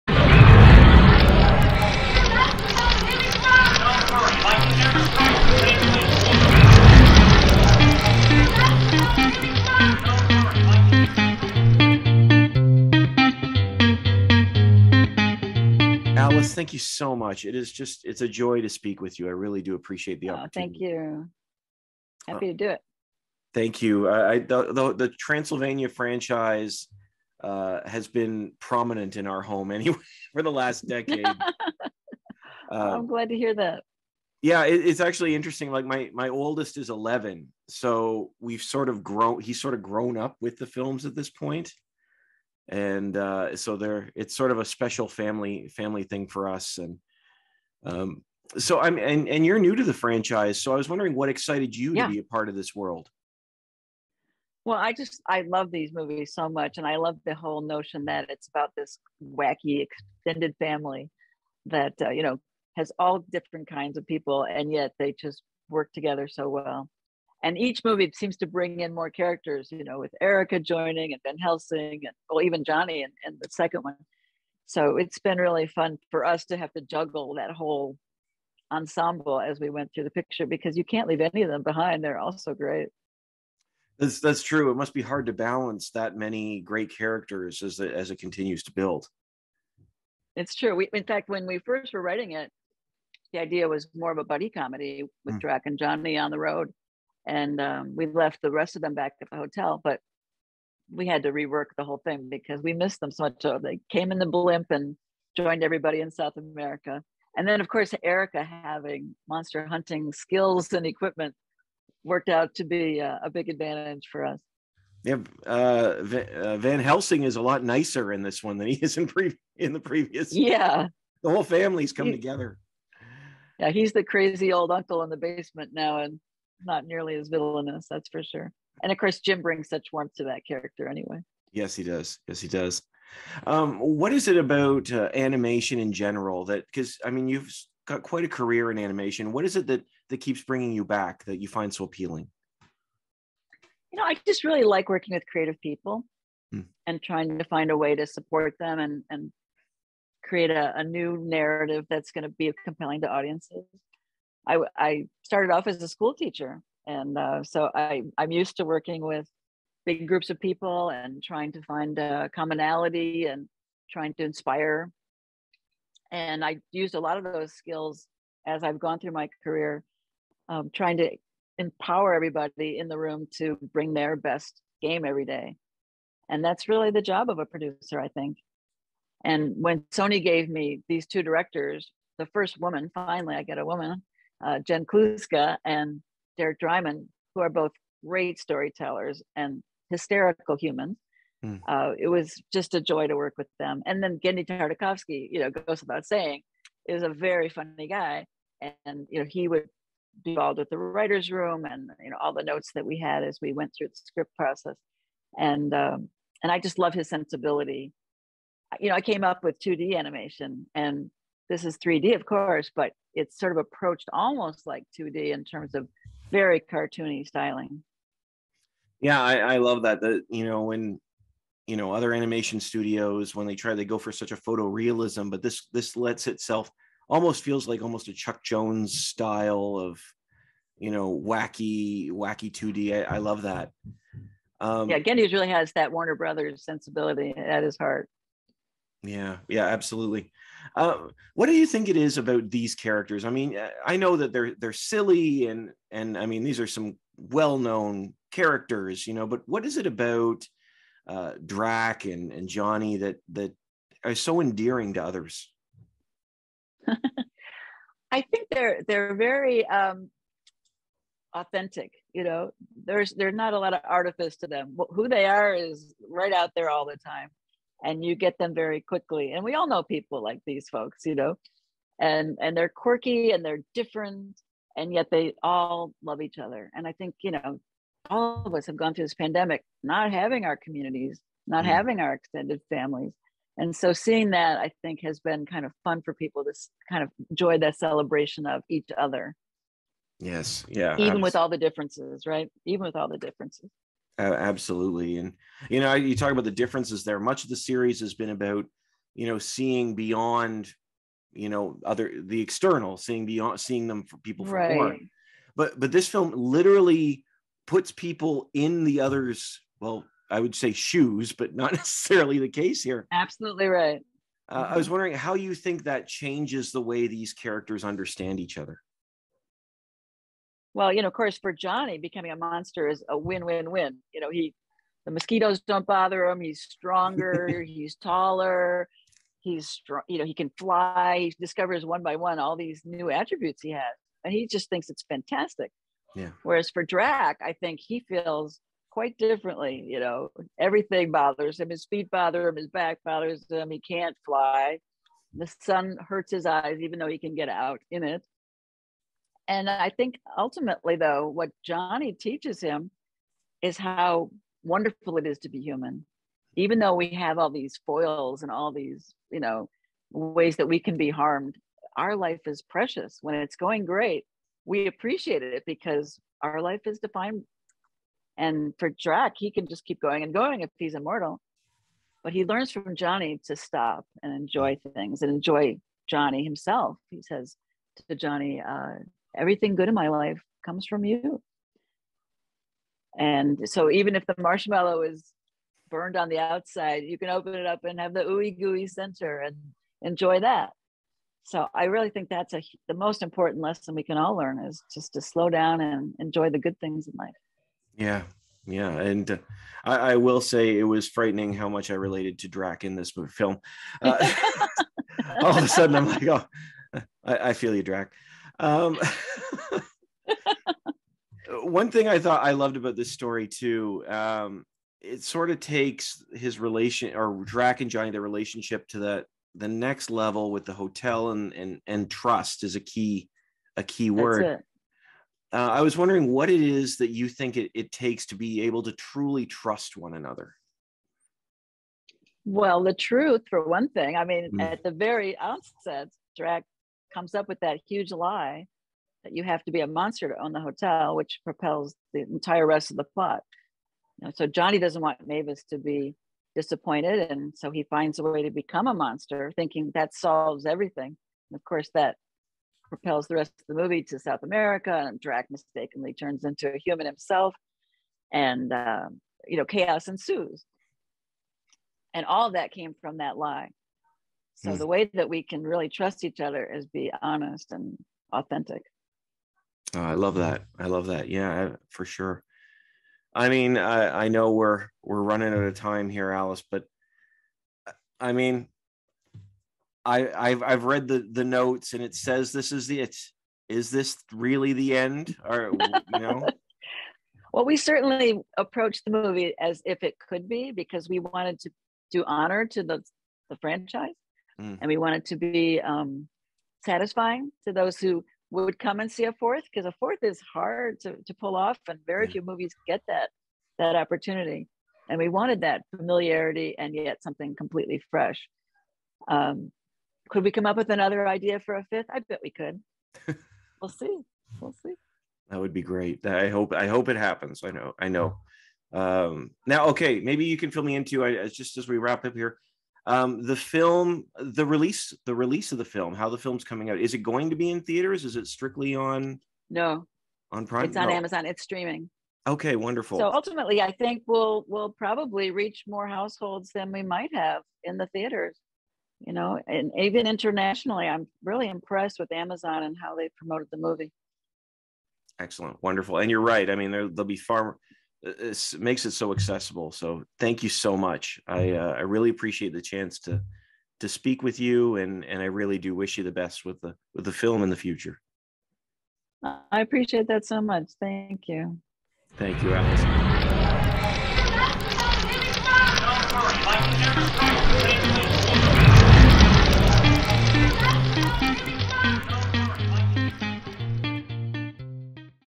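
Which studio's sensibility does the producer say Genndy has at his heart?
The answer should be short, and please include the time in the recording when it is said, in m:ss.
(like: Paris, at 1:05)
Warner Brothers, at 3:55.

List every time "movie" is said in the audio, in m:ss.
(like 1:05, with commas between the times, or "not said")
0:55, 1:07, 7:33, 8:09, 8:22, 9:03.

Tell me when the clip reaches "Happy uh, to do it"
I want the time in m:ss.
0:22.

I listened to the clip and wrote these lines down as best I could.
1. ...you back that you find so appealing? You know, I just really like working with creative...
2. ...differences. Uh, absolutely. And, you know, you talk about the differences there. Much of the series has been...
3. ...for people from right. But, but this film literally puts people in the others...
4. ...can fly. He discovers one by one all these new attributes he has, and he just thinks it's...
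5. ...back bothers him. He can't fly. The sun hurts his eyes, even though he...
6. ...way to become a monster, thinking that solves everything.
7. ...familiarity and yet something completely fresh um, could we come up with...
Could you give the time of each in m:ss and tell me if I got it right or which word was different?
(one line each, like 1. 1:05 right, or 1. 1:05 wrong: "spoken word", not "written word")
1. 2:20 right
2. 4:53 right
3. 5:04 right
4. 5:30 right
5. 5:42 right
6. 7:28 right
7. 8:25 right.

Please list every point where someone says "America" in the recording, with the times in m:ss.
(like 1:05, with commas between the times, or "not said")
1:46, 7:34.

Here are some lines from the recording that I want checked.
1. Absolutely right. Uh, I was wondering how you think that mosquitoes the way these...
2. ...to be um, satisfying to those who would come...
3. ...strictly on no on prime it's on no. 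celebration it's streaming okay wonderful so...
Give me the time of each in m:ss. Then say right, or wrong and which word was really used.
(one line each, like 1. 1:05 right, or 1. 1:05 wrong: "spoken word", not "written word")
1. 5:13 wrong: "changes", not "mosquitoes"
2. 8:15 right
3. 8:48 wrong: "amazon", not "celebration".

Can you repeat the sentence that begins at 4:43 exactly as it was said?
And so seeing that, I think, has been kind of fun for people to kind of enjoy that celebration of each other.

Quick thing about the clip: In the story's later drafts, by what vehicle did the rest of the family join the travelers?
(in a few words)
Blimp.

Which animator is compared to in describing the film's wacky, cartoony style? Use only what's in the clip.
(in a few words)
Chuck Jones.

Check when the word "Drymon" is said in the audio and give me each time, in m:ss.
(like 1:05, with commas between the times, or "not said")
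3:06.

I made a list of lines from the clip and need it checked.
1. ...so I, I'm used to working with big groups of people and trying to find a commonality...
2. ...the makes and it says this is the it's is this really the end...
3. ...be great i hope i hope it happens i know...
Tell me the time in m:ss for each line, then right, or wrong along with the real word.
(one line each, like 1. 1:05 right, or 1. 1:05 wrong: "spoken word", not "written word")
1. 2:37 right
2. 8:01 wrong: "notes", not "makes"
3. 8:35 right.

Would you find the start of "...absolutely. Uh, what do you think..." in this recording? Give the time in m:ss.
3:59.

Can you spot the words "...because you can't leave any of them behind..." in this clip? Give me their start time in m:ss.
1:20.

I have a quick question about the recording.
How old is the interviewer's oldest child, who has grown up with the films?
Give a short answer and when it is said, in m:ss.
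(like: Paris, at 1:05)
11, at 0:36.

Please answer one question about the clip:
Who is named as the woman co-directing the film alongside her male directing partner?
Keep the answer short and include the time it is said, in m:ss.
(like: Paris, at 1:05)
Jen Kluska, at 3:04.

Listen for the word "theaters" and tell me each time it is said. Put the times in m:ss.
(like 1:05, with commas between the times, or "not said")
8:47, 8:58.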